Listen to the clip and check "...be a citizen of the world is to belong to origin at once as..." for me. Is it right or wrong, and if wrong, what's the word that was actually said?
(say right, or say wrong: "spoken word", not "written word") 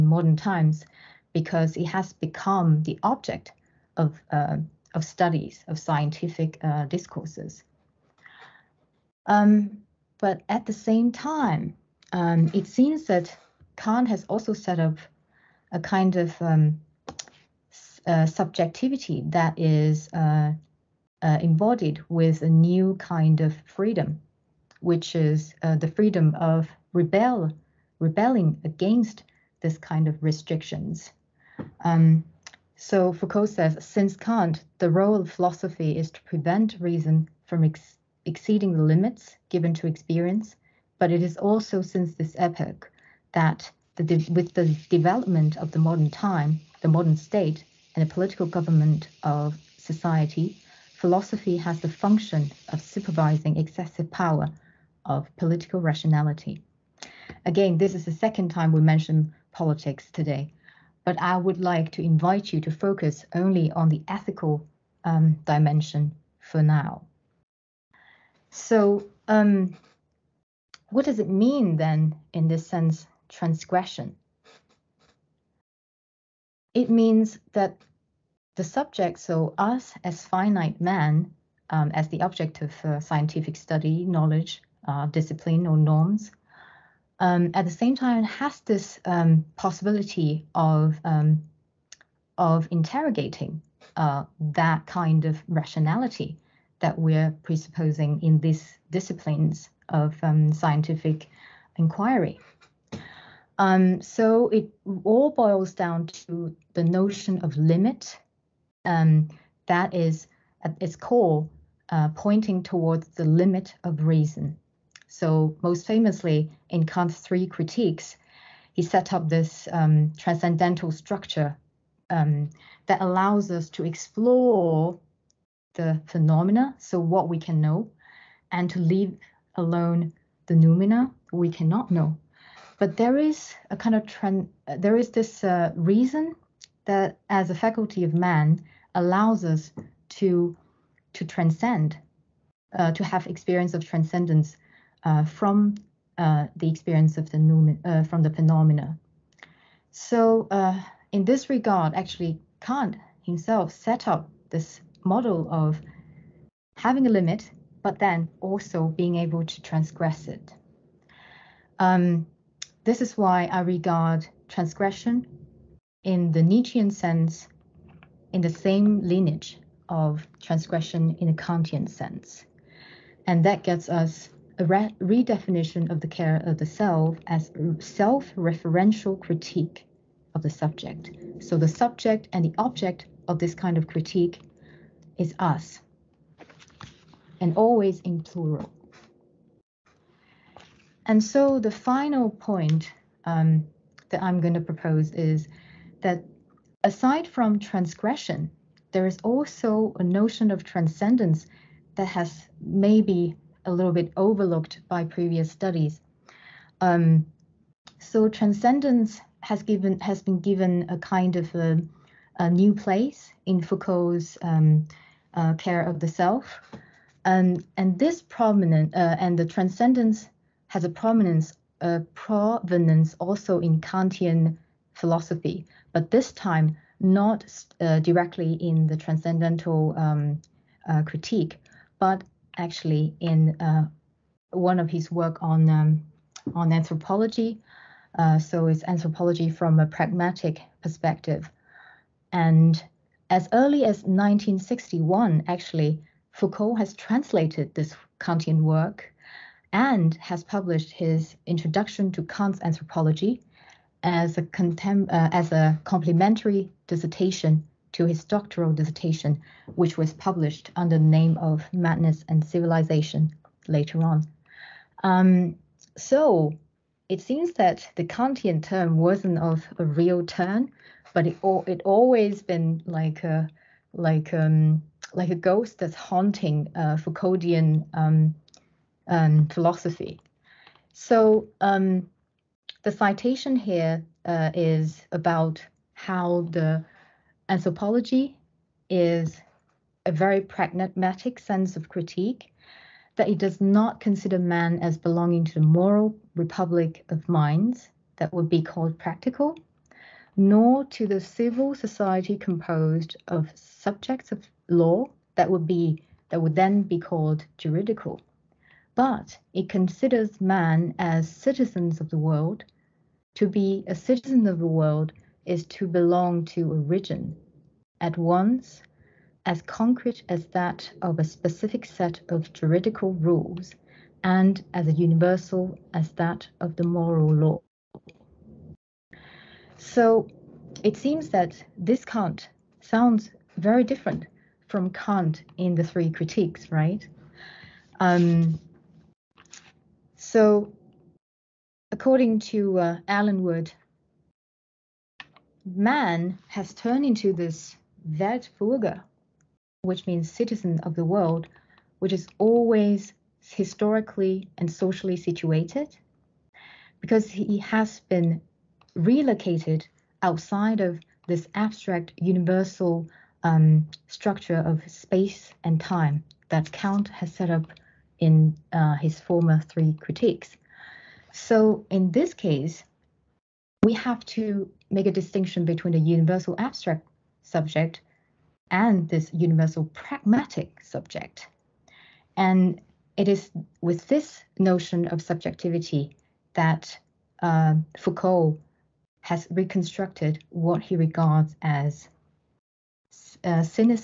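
right.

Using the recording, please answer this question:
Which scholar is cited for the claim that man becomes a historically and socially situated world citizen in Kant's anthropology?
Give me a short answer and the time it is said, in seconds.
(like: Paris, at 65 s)
Allen Wood, at 343 s.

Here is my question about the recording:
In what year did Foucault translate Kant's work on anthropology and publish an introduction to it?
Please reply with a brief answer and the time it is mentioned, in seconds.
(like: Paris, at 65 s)
1961, at 244 s.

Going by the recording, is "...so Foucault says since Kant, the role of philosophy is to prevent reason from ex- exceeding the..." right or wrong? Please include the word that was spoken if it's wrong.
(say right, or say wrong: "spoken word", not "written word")
right.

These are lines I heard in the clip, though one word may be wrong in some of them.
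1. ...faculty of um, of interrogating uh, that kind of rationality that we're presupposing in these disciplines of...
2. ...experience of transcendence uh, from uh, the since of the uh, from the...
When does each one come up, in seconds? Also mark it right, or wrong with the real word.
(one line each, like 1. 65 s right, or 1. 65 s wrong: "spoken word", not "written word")
1. 89 s wrong: "possibility", not "faculty"
2. 143 s wrong: "experience", not "since".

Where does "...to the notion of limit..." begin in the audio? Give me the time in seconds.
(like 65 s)
106 s.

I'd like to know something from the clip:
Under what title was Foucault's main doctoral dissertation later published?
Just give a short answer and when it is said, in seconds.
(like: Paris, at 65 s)
Madness and Civilization, at 261 s.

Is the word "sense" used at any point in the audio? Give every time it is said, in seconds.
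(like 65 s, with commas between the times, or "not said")
72 s, 166 s, 171 s, 291 s.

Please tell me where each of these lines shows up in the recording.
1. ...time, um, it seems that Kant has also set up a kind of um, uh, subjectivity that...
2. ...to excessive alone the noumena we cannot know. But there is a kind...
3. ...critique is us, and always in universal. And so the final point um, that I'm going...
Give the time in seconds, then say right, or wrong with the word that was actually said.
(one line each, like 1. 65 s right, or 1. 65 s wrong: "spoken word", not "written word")
1. 11 s right
2. 128 s wrong: "leave", not "excessive"
3. 183 s wrong: "plural", not "universal".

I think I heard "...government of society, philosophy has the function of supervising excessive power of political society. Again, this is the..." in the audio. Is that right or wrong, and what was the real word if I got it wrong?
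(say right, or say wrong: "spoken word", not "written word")
wrong: "rationality", not "society".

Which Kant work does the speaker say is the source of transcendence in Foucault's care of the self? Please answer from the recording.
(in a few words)
Anthropology from a Pragmatic Perspective.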